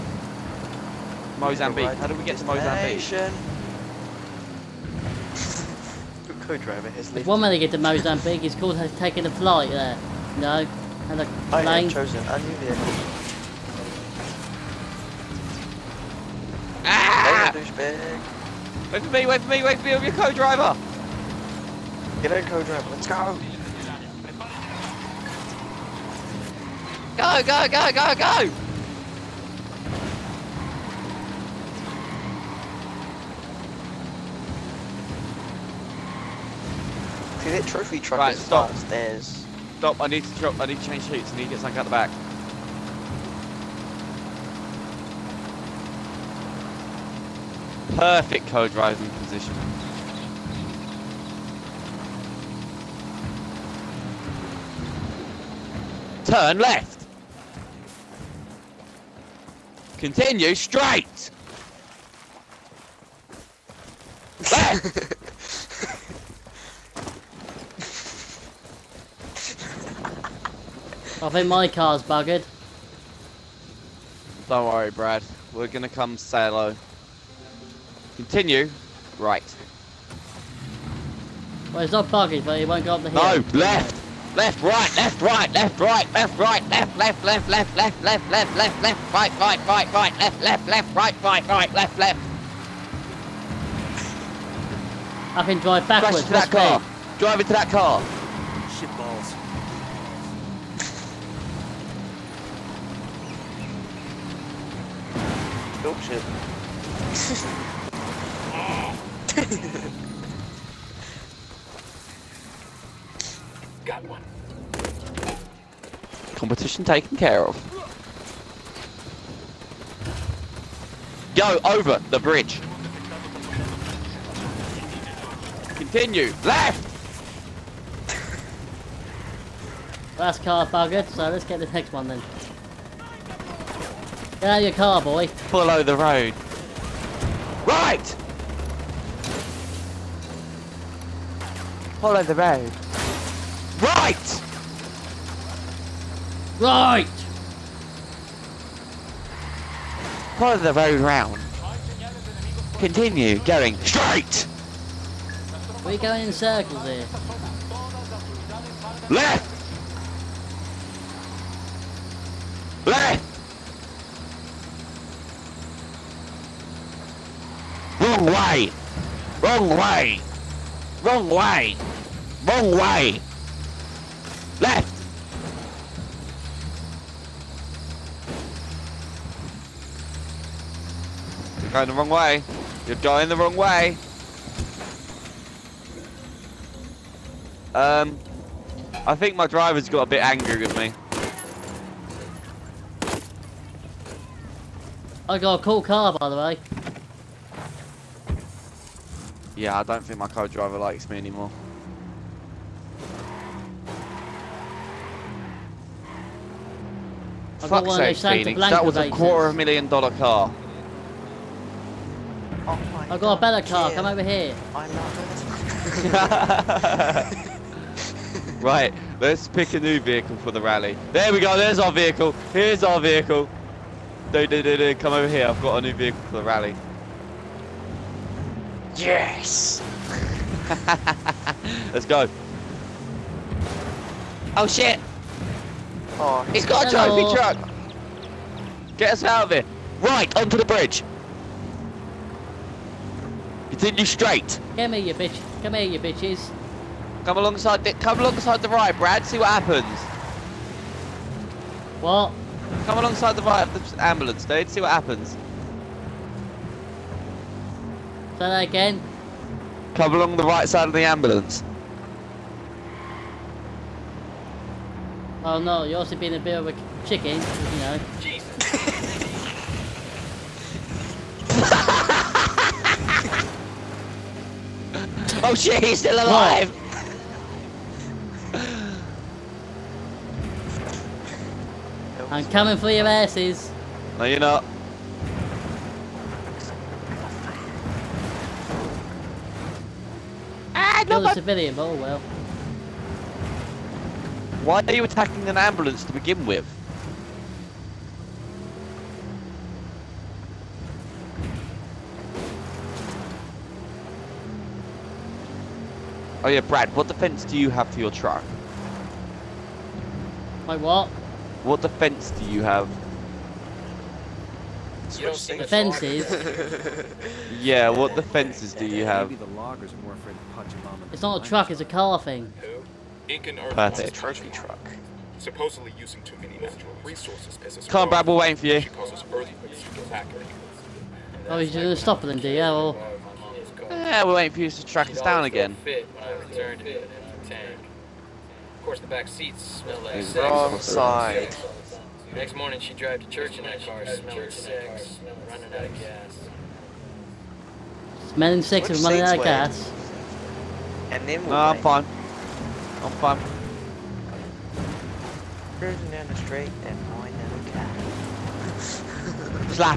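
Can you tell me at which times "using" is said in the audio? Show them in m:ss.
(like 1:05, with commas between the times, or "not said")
5:25.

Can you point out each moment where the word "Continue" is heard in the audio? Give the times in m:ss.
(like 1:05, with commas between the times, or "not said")
0:59, 1:18, 2:05, 2:32, 4:03.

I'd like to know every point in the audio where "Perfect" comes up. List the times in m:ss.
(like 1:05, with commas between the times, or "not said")
0:47, 5:23.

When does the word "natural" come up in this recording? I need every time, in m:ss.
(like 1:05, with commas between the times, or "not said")
5:26.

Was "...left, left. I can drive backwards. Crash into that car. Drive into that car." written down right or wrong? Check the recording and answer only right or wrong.
right.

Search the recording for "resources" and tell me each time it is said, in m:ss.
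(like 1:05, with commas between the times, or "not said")
5:27.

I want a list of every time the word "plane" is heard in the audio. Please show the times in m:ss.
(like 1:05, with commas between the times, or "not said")
0:11.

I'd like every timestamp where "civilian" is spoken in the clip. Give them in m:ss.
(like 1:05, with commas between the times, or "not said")
4:51.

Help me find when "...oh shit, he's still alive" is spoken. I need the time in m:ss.
4:35.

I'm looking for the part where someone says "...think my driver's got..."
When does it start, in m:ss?
3:09.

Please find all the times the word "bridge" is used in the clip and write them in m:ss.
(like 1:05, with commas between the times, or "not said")
2:02, 4:00.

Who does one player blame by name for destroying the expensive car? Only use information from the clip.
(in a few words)
Phoenix.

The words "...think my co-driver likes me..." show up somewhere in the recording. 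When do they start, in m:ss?
3:20.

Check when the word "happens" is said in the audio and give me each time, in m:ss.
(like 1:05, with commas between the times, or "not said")
4:09, 4:14.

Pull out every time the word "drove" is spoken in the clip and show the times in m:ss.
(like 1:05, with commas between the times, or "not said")
5:42.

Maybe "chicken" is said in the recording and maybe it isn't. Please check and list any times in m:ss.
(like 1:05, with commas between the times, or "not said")
4:27.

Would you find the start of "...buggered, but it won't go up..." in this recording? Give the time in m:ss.
1:22.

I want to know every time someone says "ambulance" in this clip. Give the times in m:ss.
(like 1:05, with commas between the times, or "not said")
4:14, 4:21, 4:55.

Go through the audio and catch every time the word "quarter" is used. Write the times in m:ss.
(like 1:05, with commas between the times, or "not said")
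3:29.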